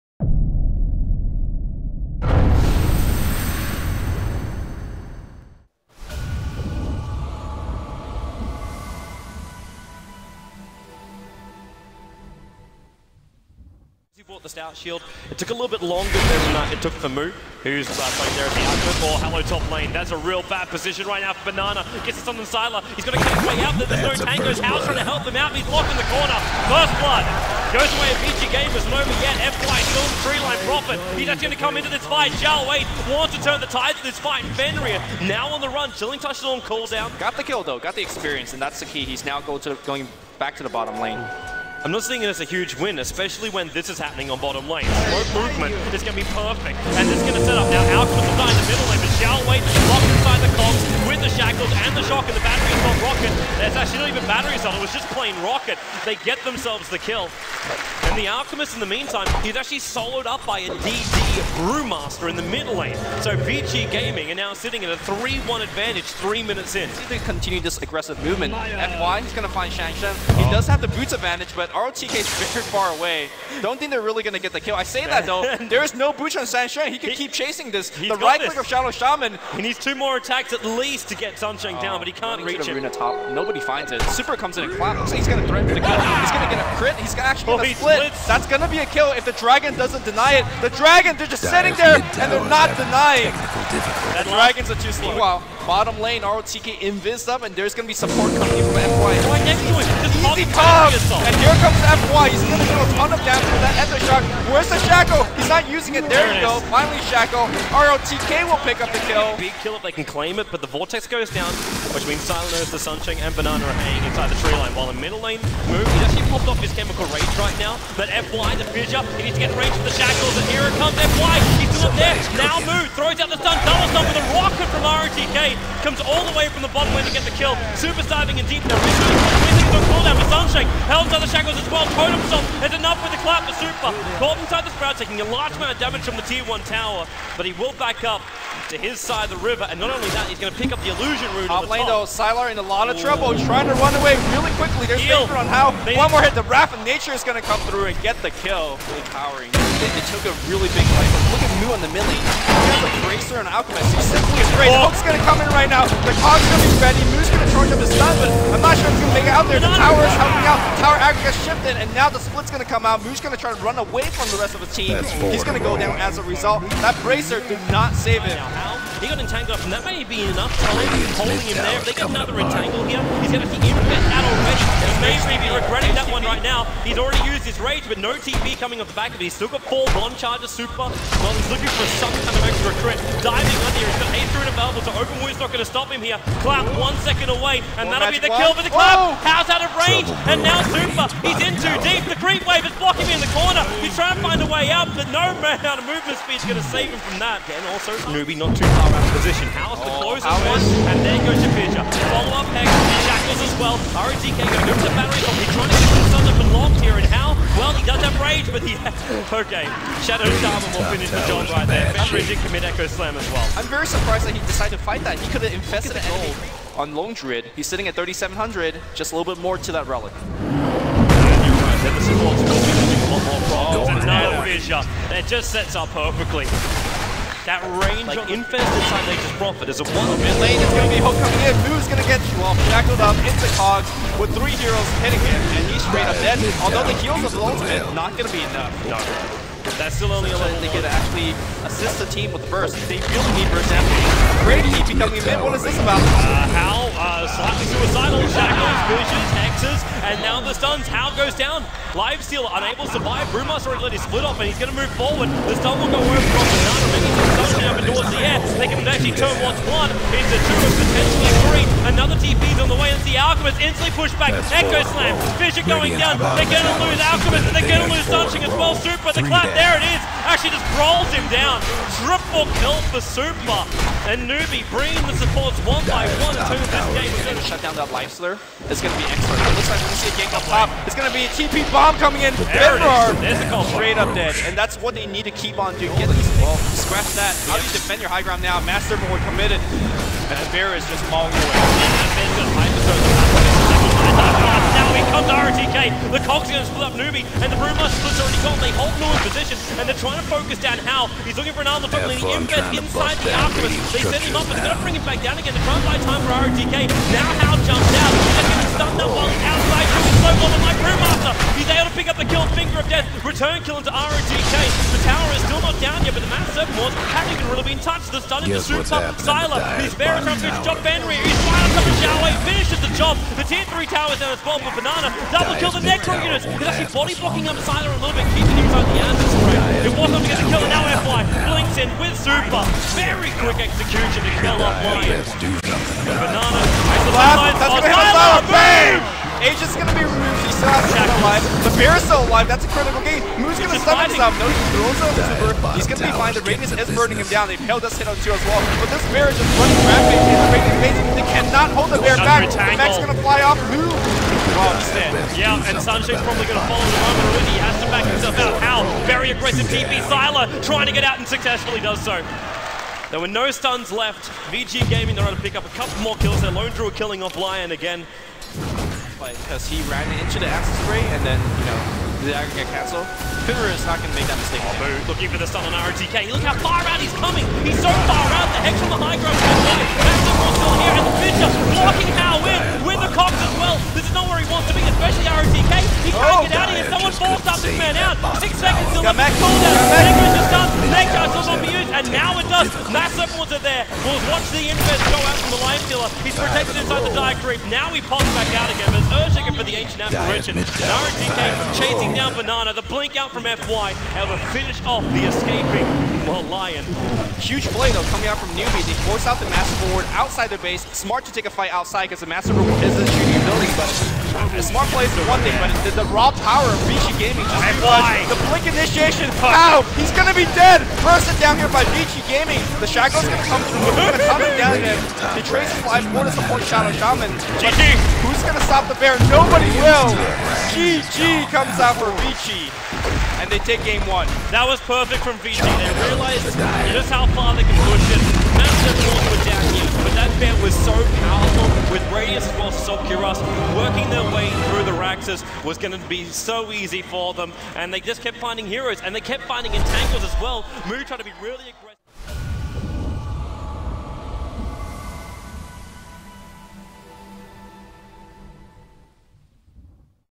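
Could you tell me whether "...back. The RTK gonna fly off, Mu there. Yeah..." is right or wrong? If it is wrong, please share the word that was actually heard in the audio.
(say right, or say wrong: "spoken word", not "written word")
wrong: "Max", not "RTK".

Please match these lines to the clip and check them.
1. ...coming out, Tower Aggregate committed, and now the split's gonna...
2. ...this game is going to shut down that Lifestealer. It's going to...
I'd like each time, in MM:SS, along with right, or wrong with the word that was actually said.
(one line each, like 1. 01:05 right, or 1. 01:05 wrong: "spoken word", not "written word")
1. 02:40 wrong: "shifted", not "committed"
2. 04:36 right.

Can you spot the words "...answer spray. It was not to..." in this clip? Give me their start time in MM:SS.
05:29.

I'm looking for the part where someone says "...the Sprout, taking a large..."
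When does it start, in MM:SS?
02:14.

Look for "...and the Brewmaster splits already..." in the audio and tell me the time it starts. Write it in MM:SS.
04:57.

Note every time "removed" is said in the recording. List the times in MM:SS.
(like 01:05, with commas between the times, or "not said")
05:40.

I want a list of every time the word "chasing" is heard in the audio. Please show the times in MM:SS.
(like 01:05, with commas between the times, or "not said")
01:17, 06:41.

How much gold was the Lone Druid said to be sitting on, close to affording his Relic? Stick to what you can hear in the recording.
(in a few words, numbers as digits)
3,700.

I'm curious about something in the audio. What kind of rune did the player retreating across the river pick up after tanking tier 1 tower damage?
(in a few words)
Illusion rune.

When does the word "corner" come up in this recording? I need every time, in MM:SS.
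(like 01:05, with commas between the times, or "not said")
00:26, 03:13.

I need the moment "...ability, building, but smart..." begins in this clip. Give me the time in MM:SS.
06:53.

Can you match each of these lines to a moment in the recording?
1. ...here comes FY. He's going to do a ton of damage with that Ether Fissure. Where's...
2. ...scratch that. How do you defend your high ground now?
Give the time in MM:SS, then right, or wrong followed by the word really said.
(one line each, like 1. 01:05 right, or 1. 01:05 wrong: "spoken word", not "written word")
1. 01:41 wrong: "Shock", not "Fissure"
2. 04:46 right.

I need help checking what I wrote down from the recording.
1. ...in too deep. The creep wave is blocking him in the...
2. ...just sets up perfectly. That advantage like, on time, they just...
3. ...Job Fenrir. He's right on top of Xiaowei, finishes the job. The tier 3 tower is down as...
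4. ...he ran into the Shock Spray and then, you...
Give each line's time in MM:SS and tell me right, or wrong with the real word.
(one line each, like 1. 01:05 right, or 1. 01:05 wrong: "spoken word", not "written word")
1. 03:11 right
2. 03:45 wrong: "range", not "advantage"
3. 05:20 right
4. 06:09 wrong: "Acid", not "Shock".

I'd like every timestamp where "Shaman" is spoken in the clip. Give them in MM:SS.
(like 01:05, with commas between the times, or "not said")
01:18, 03:30, 07:06.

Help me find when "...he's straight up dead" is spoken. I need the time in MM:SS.
03:55.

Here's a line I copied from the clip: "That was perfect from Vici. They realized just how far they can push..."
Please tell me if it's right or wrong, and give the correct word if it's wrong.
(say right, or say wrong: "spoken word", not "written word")
right.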